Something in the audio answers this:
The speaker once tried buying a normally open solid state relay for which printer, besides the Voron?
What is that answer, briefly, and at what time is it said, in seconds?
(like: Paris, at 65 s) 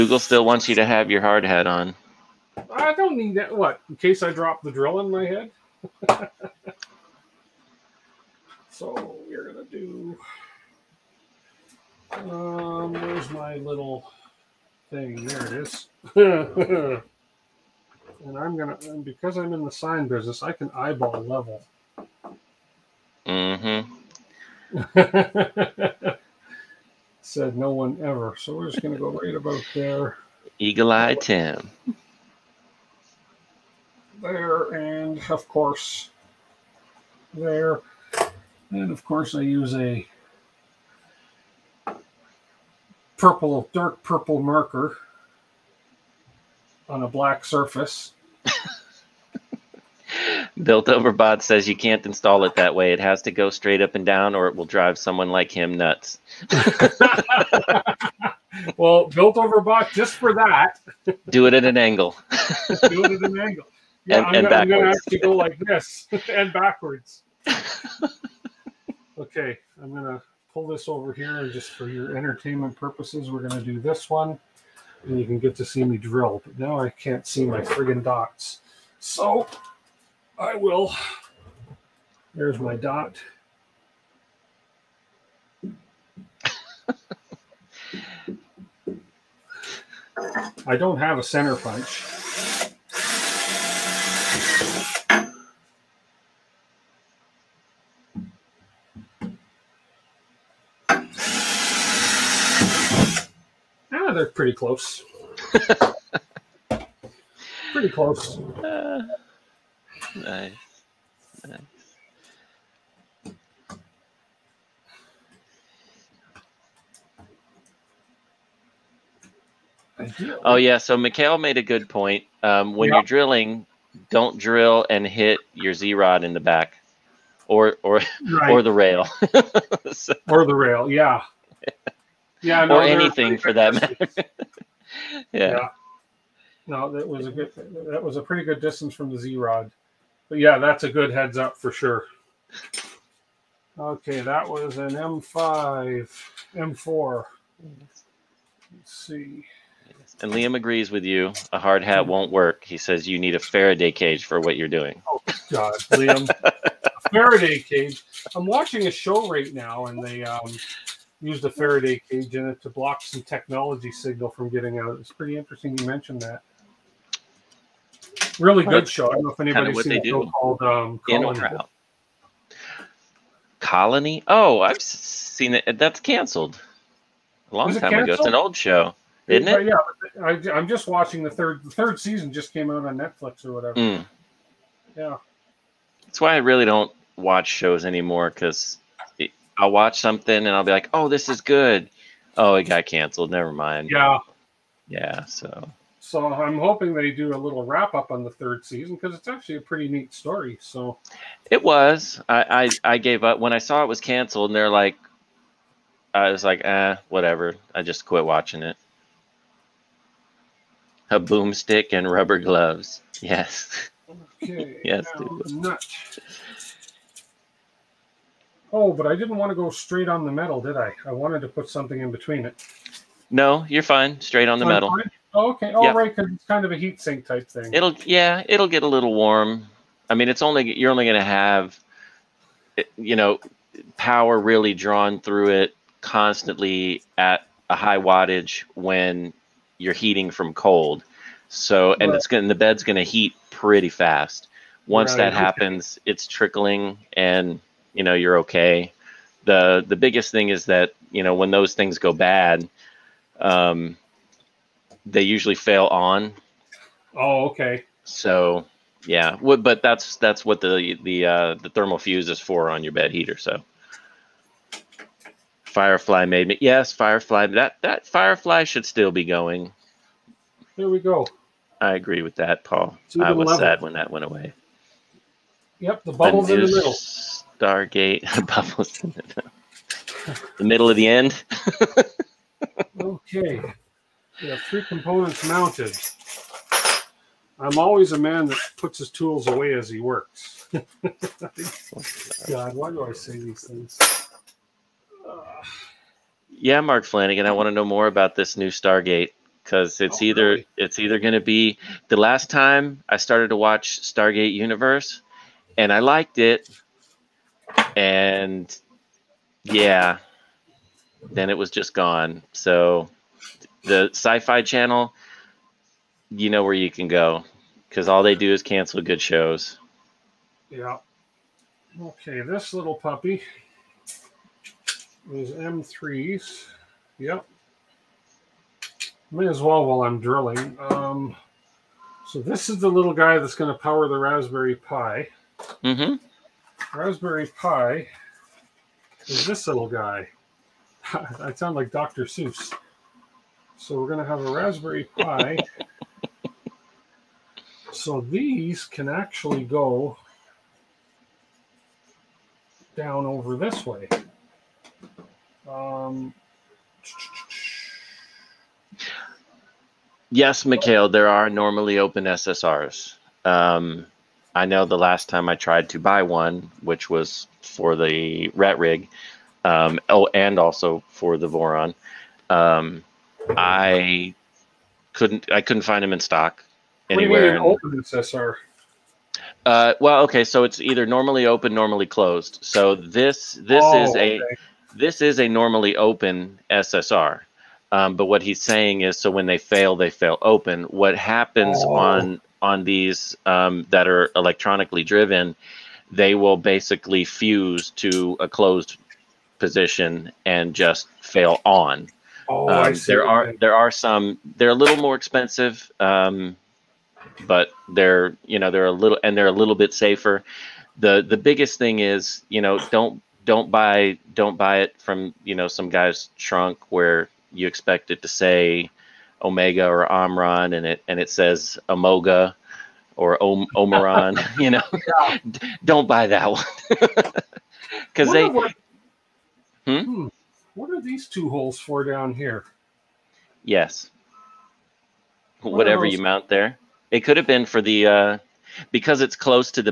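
Rat Rig, at 368 s.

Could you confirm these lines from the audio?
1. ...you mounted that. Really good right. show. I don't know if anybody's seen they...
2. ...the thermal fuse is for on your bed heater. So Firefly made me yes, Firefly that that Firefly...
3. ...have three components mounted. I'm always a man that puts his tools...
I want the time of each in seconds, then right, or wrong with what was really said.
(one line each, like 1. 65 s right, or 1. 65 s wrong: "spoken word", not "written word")
1. 165 s wrong: "mentioned", not "mounted"
2. 261 s right
3. 284 s right.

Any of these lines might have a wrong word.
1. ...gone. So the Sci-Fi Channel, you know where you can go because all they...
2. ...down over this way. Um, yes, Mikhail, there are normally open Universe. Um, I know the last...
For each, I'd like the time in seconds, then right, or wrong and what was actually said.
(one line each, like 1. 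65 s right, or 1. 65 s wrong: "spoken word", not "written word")
1. 311 s right
2. 352 s wrong: "SSRs", not "Universe".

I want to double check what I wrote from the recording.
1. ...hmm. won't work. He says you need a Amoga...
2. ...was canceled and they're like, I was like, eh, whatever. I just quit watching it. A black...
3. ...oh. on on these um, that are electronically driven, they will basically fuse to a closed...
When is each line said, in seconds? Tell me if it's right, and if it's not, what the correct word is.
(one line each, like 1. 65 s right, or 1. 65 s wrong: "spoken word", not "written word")
1. 152 s wrong: "Faraday", not "Amoga"
2. 203 s wrong: "boomstick", not "black"
3. 391 s right.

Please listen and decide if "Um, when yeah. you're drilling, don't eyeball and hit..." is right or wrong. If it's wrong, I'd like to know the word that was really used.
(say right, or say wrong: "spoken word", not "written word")
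wrong: "drill", not "eyeball".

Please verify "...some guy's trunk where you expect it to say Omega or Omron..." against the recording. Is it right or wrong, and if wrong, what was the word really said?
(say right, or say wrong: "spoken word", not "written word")
right.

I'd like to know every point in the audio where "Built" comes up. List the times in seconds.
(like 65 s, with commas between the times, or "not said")
50 s, 59 s.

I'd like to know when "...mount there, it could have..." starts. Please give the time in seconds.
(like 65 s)
436 s.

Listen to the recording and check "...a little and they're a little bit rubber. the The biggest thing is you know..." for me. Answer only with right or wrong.
wrong.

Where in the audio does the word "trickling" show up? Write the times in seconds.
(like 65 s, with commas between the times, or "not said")
246 s.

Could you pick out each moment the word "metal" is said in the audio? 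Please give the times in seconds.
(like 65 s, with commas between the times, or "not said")
220 s, 224 s.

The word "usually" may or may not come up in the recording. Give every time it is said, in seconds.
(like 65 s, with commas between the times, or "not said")
255 s.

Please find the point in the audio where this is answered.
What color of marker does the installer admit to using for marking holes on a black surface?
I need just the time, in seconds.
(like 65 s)
43 s.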